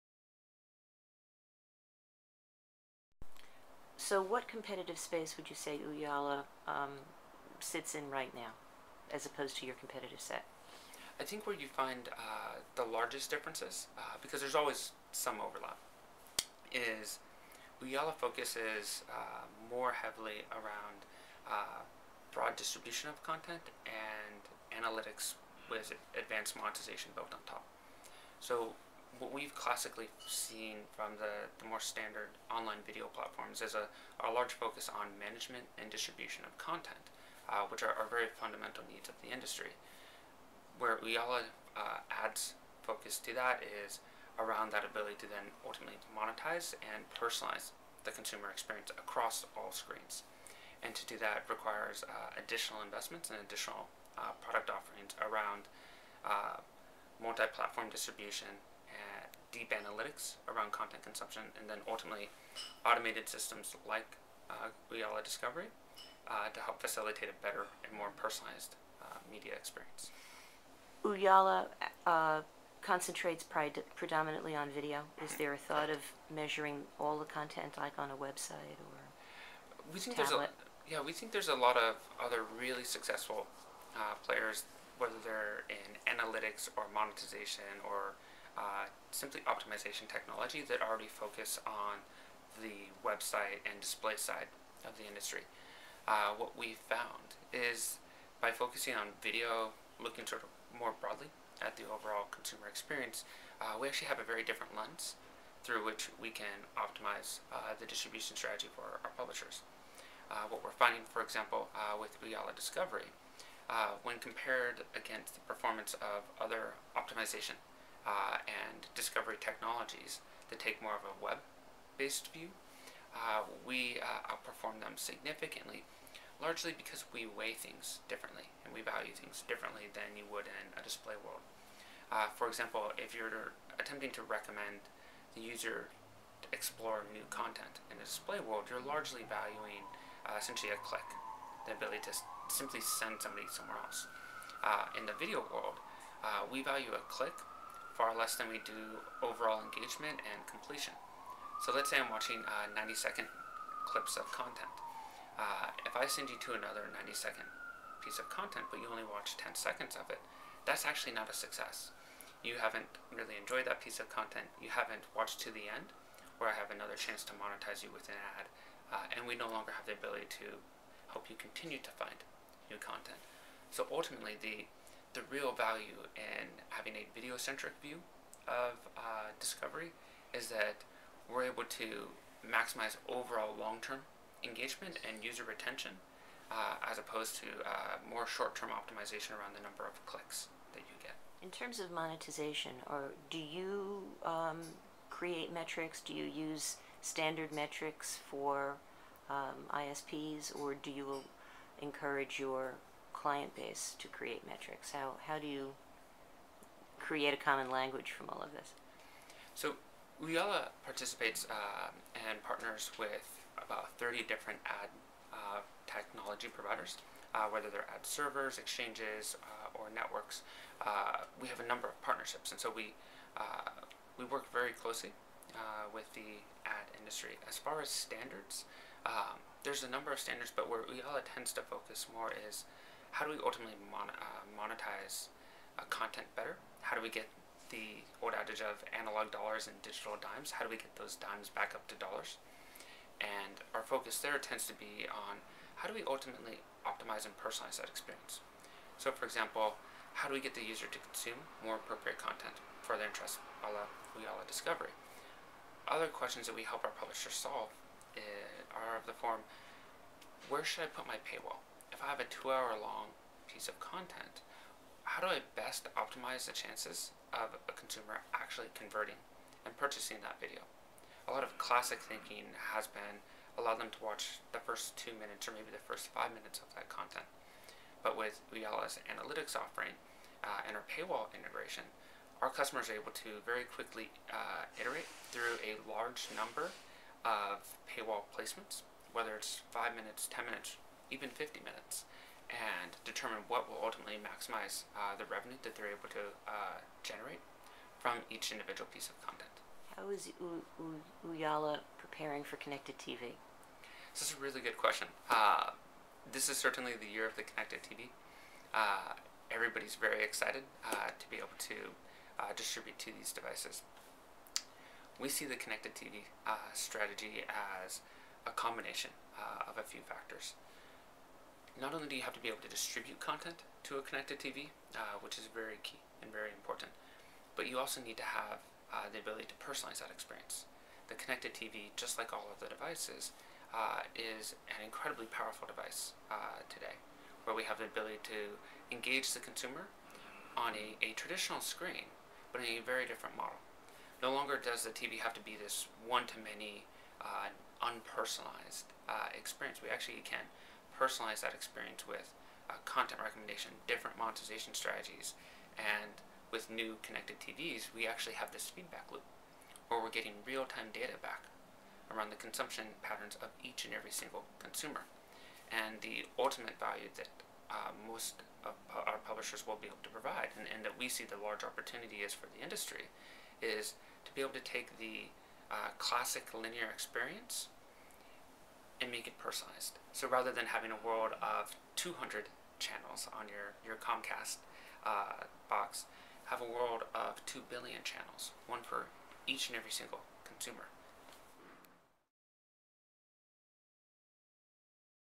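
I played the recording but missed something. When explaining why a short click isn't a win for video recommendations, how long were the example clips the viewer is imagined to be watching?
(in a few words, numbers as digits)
90 seconds.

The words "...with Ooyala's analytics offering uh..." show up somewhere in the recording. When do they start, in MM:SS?
04:38.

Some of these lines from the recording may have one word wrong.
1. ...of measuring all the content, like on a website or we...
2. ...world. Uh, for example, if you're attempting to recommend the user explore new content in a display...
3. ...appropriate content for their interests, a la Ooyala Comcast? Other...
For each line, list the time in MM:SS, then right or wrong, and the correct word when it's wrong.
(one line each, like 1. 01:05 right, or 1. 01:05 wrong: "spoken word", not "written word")
1. 01:15 right
2. 02:11 right
3. 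04:11 wrong: "Discovery", not "Comcast".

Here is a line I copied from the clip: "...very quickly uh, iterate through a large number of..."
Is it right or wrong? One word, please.
right.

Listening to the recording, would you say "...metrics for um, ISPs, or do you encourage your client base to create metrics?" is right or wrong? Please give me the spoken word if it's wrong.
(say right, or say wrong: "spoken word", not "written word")
right.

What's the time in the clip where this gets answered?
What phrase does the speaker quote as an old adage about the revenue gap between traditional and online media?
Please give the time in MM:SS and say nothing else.
03:58.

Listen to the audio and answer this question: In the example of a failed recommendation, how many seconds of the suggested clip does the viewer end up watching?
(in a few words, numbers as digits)
10 seconds.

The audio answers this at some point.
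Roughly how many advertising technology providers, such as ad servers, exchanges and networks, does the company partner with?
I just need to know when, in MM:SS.
03:33.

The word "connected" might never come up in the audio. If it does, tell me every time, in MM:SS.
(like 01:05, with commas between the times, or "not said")
05:02, 05:07, 05:15, 05:24, 05:31, 05:57.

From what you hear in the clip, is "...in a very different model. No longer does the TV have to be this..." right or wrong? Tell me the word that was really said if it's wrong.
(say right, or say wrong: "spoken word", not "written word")
right.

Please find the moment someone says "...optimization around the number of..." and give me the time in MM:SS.
03:08.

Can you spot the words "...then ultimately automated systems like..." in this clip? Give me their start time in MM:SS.
01:01.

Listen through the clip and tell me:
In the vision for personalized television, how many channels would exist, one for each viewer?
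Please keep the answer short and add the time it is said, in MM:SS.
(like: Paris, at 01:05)
2 billion, at 06:27.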